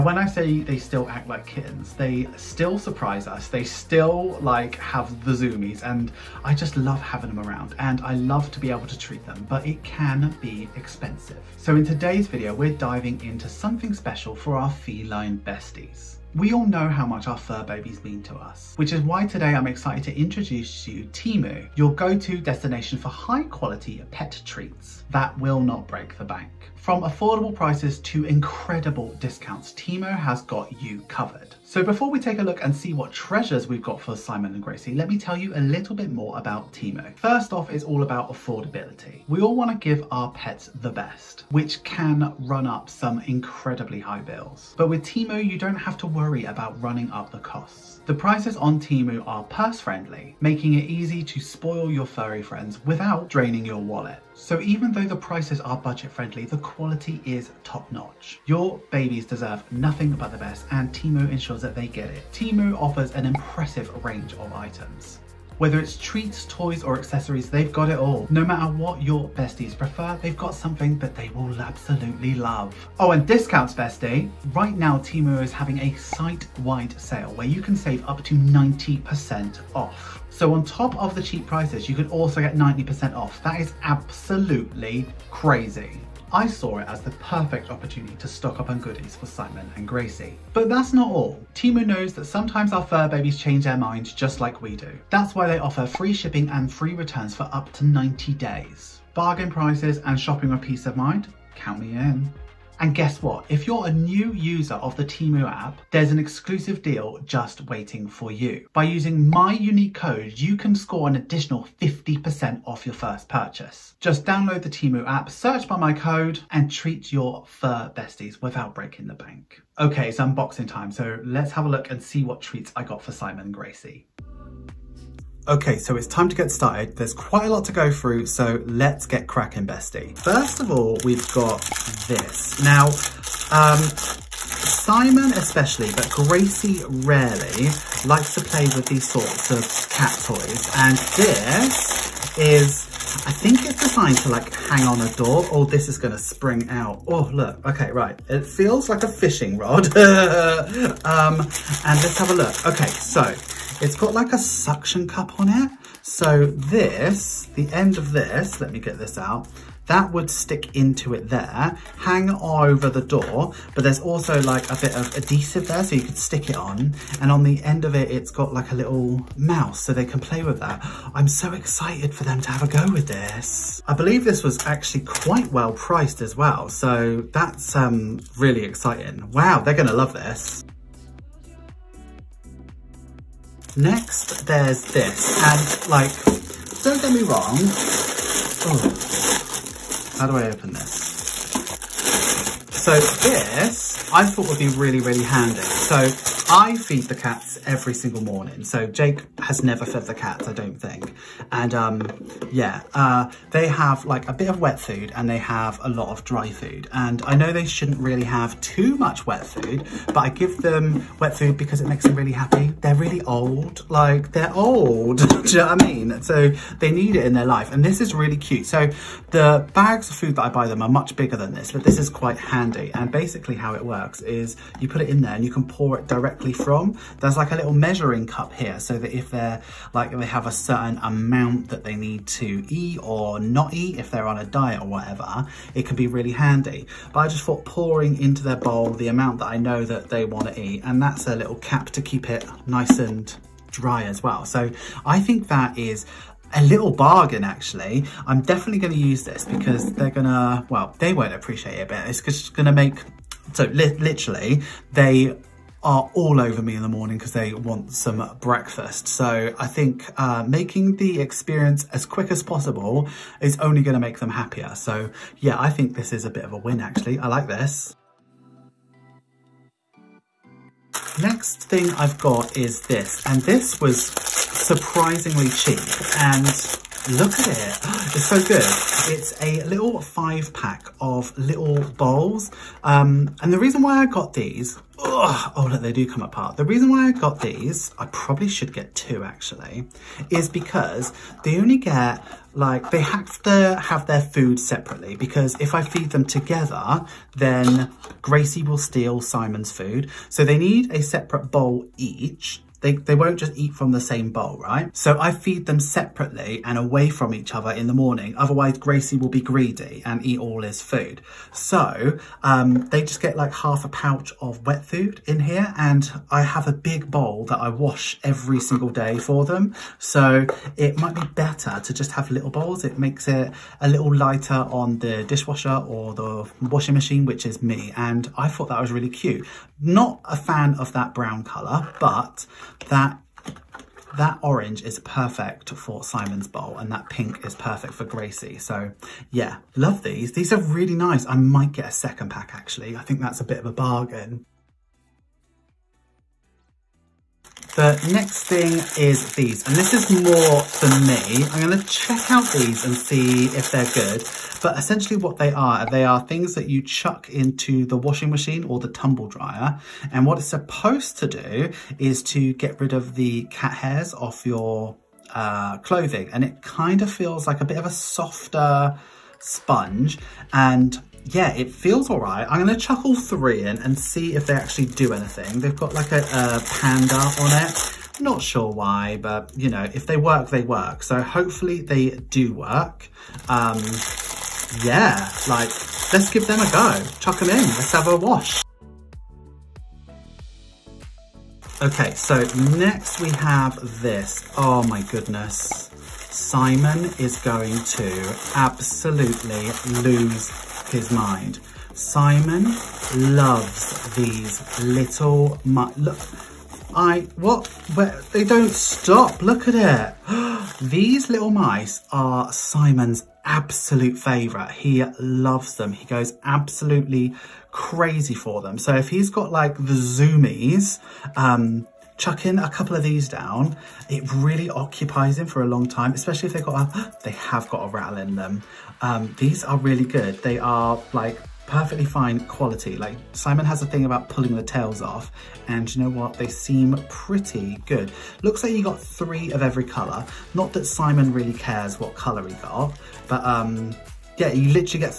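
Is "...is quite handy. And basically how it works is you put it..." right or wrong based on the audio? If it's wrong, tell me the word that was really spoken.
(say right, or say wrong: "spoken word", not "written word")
right.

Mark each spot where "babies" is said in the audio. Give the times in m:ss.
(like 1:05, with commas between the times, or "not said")
0:17, 0:58, 1:33.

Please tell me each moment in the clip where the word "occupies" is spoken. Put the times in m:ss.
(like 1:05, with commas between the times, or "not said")
7:04.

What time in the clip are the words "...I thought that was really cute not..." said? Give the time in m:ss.
5:28.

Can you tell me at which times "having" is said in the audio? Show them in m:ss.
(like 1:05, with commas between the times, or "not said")
0:07, 1:15.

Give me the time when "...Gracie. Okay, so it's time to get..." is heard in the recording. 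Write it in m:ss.
2:03.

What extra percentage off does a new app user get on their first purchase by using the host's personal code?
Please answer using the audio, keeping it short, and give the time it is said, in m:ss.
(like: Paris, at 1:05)
50%, at 1:51.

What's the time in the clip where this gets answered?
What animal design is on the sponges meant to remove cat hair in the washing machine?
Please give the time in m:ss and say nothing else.
6:16.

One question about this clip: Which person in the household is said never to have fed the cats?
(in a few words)
Jake.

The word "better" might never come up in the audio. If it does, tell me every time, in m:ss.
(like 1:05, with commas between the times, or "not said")
5:21.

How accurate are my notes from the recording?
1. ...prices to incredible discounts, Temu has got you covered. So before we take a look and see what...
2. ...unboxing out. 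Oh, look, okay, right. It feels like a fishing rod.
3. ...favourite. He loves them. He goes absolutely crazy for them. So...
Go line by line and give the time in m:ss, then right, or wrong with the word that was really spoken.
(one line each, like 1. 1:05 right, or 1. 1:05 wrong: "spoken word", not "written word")
1. 0:27 right
2. 2:26 wrong: "spring", not "unboxing"
3. 6:54 right.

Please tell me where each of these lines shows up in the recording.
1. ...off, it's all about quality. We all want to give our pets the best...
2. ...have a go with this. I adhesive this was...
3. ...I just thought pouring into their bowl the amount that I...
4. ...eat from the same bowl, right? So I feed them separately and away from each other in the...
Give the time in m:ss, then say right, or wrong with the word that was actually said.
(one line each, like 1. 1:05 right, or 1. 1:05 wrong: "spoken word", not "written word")
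1. 0:37 wrong: "affordability", not "quality"
2. 2:52 wrong: "believe", not "adhesive"
3. 3:57 right
4. 5:03 right.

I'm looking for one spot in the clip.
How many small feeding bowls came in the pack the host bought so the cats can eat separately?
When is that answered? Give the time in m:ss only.
4:40.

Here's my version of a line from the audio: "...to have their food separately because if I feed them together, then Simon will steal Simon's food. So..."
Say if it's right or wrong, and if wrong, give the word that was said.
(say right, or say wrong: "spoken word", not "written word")
wrong: "Gracie", not "Simon".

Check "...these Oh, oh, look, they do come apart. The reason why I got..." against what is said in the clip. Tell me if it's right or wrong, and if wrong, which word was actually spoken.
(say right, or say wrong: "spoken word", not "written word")
right.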